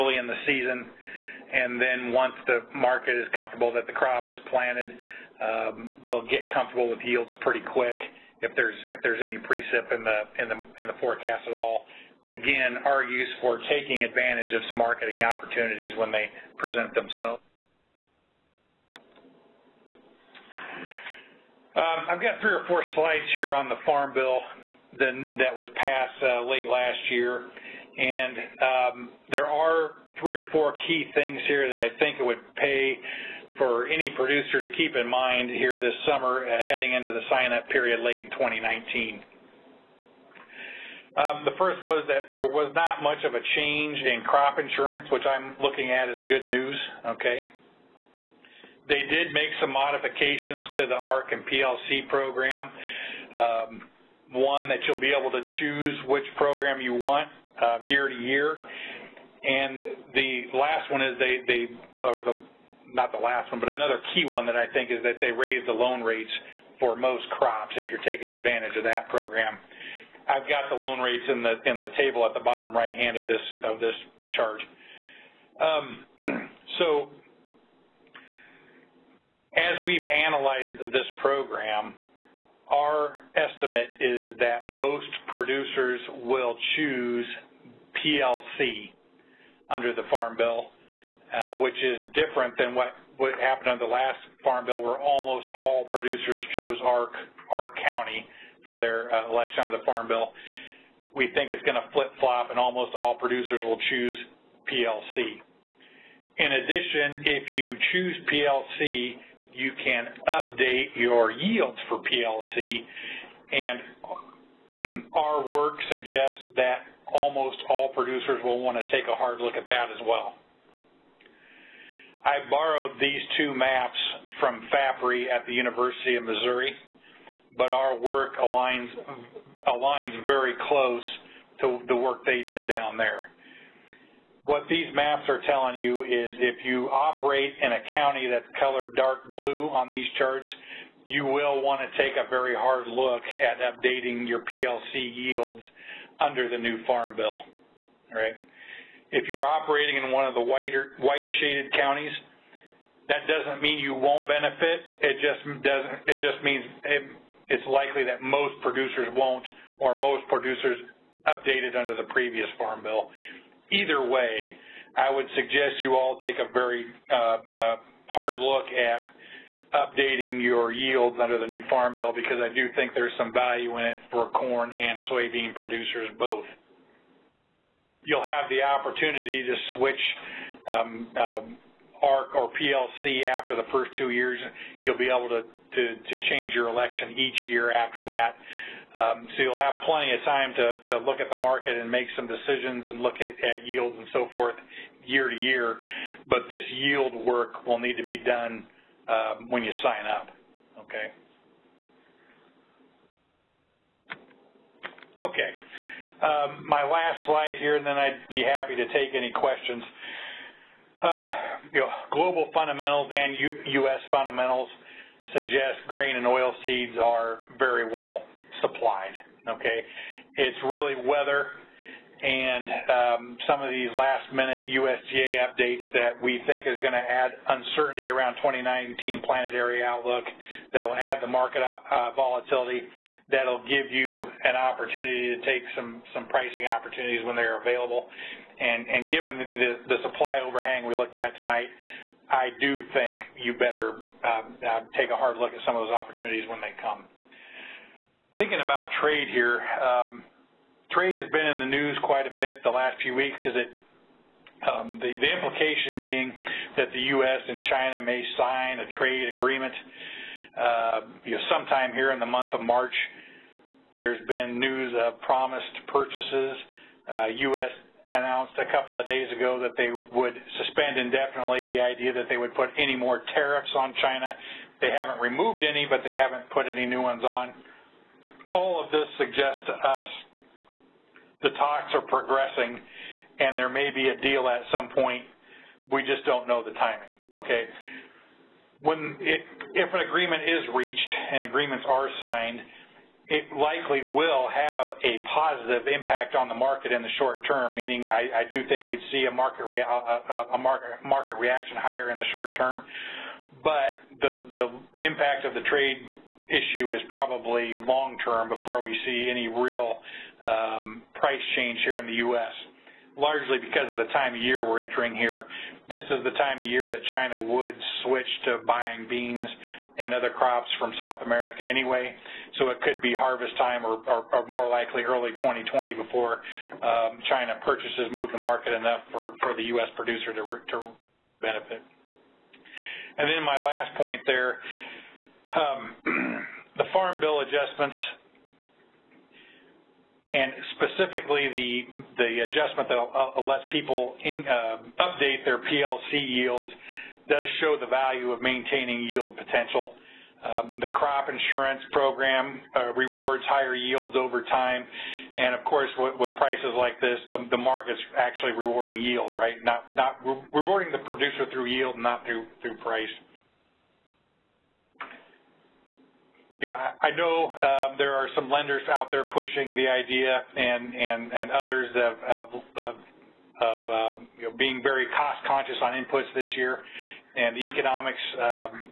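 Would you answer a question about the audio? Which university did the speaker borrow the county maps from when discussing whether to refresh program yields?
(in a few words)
University of Missouri.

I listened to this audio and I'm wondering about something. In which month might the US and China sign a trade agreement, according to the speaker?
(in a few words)
March.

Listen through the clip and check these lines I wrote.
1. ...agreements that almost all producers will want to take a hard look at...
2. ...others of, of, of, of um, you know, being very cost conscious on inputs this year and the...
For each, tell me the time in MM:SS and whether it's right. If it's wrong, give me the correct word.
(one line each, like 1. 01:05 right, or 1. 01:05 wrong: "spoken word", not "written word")
1. 01:55 wrong: "suggests", not "agreements"
2. 06:11 right.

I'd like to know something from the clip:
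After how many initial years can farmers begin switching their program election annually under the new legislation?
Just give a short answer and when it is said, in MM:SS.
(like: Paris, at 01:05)
2, at 03:03.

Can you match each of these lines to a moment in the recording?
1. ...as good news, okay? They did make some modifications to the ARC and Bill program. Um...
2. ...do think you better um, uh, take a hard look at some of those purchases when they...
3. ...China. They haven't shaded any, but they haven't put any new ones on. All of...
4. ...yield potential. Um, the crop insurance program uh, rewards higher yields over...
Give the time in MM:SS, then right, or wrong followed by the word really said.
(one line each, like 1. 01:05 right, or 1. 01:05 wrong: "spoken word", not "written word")
1. 00:46 wrong: "PLC", not "Bill"
2. 04:02 wrong: "opportunities", not "purchases"
3. 04:34 wrong: "removed", not "shaded"
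4. 05:49 right.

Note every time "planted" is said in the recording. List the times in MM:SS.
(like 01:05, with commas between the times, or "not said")
00:04, 03:49.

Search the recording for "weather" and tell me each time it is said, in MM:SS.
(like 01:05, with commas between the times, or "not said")
03:41.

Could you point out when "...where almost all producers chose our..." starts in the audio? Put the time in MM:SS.
01:34.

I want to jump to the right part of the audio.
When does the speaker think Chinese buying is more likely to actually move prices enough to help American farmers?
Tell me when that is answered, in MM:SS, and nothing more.
05:25.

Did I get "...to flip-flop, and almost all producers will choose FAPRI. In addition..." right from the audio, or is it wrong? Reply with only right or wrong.
wrong.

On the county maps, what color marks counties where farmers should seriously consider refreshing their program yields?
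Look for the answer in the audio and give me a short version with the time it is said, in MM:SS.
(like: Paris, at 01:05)
dark blue, at 02:18.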